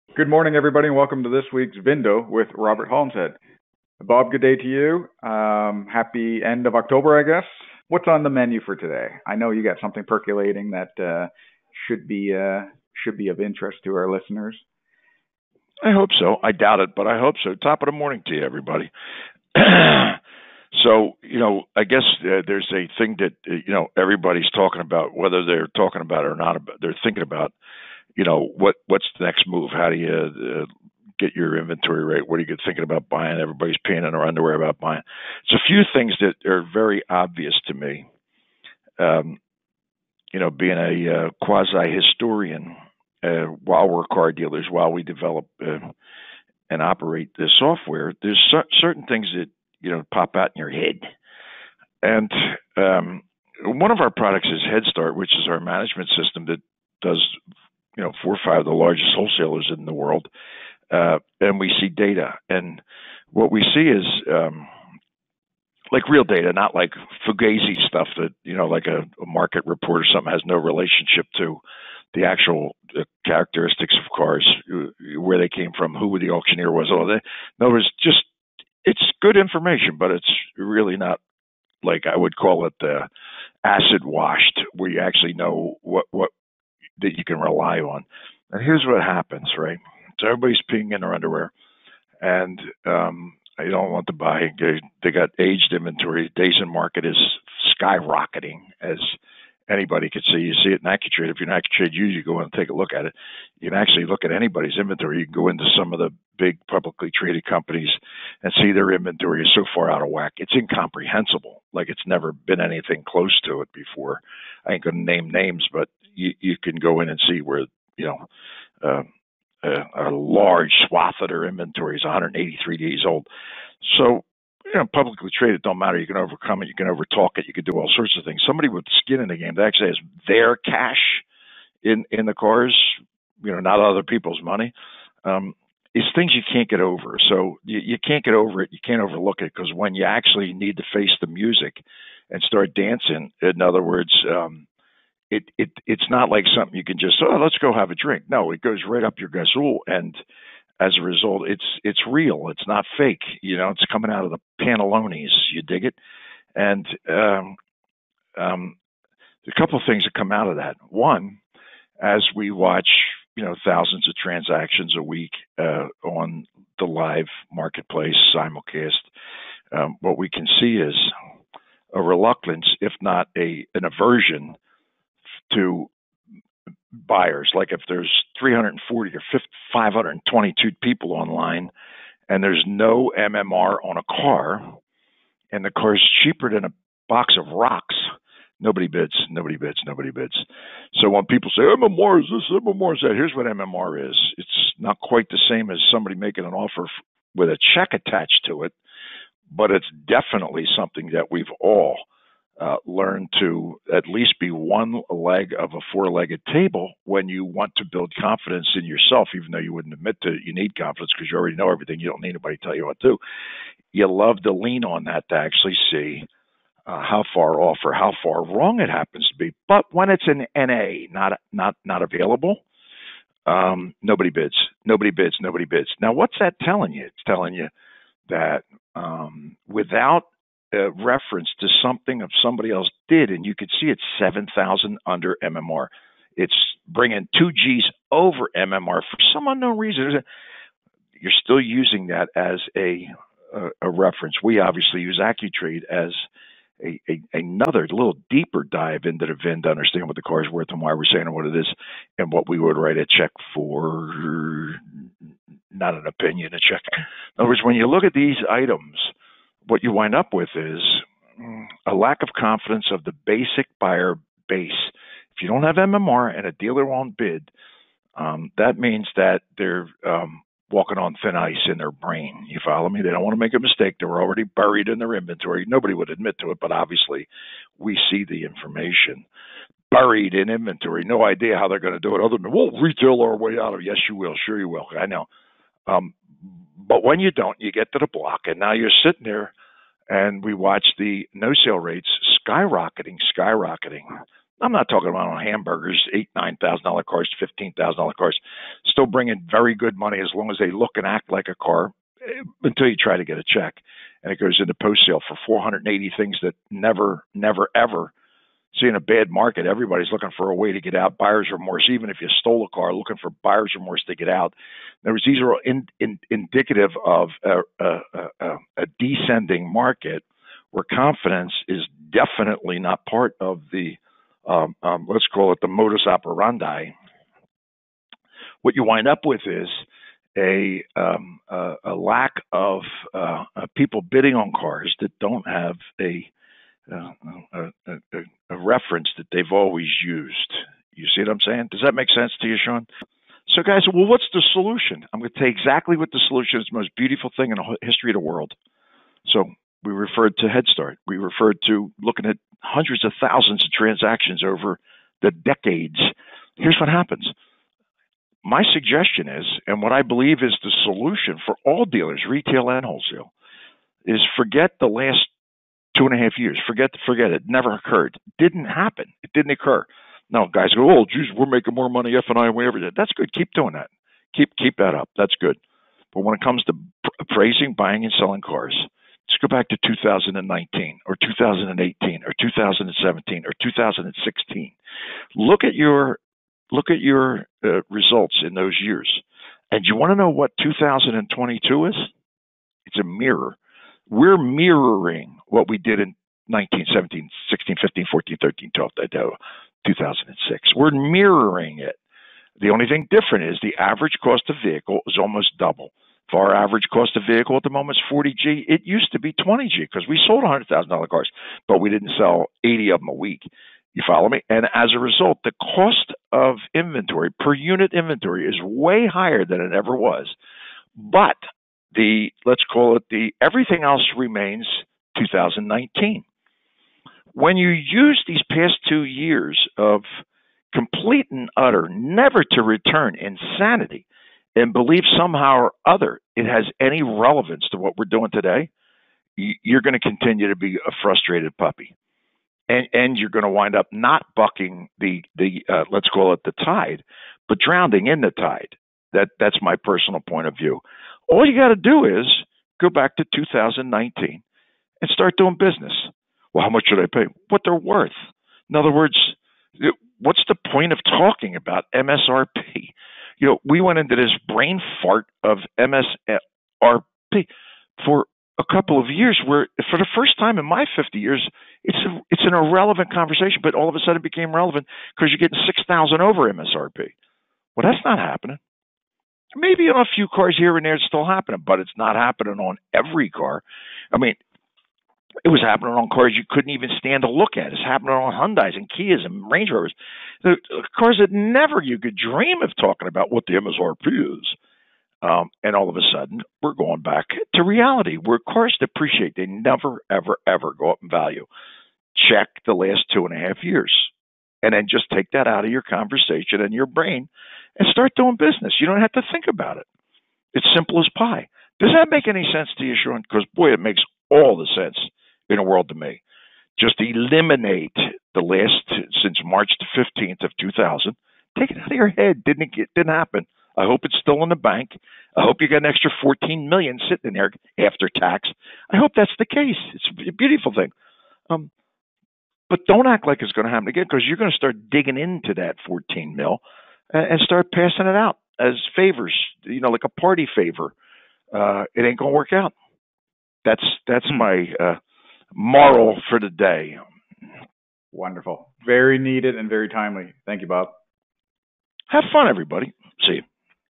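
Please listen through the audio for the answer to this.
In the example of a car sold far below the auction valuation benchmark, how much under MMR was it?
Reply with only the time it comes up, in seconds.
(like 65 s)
234 s.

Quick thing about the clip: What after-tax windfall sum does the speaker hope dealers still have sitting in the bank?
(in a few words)
14 million.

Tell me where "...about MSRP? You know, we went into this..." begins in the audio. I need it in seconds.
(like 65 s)
461 s.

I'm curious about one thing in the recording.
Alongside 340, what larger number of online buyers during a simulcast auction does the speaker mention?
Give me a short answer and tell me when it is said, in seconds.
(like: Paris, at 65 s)
522, at 179 s.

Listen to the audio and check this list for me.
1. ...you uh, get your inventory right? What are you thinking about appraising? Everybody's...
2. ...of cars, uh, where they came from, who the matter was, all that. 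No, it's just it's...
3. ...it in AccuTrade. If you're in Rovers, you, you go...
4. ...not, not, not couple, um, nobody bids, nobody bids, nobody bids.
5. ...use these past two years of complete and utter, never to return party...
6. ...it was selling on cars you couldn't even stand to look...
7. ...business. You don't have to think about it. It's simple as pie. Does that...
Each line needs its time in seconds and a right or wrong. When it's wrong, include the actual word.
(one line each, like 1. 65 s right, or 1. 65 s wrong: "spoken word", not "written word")
1. 29 s wrong: "buying", not "appraising"
2. 73 s wrong: "auctioneer", not "matter"
3. 100 s wrong: "AccuTrade", not "Rovers"
4. 221 s wrong: "available", not "couple"
5. 427 s wrong: "insanity", not "party"
6. 485 s wrong: "happening", not "selling"
7. 508 s right.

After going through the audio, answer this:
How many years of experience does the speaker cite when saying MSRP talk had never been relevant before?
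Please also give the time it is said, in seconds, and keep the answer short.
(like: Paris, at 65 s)
50 years, at 470 s.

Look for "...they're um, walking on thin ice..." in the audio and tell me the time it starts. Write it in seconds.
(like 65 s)
269 s.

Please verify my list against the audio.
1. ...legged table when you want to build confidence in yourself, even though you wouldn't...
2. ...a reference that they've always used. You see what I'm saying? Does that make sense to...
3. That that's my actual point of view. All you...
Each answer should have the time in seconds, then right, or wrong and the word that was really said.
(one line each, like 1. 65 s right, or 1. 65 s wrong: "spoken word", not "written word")
1. 206 s right
2. 338 s right
3. 449 s wrong: "personal", not "actual".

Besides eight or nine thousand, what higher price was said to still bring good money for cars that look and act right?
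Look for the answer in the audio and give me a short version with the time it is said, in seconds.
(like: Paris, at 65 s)
$15,000, at 297 s.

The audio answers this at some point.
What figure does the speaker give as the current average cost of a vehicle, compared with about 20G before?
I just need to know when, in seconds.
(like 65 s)
408 s.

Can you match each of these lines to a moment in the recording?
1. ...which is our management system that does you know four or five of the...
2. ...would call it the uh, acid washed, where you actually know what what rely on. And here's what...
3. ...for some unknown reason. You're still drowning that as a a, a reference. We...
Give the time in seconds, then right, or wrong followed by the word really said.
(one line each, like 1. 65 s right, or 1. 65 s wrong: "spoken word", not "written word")
1. 55 s right
2. 82 s right
3. 239 s wrong: "using", not "drowning".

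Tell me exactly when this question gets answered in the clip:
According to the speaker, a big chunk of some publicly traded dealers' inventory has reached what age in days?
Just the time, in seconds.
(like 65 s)
122 s.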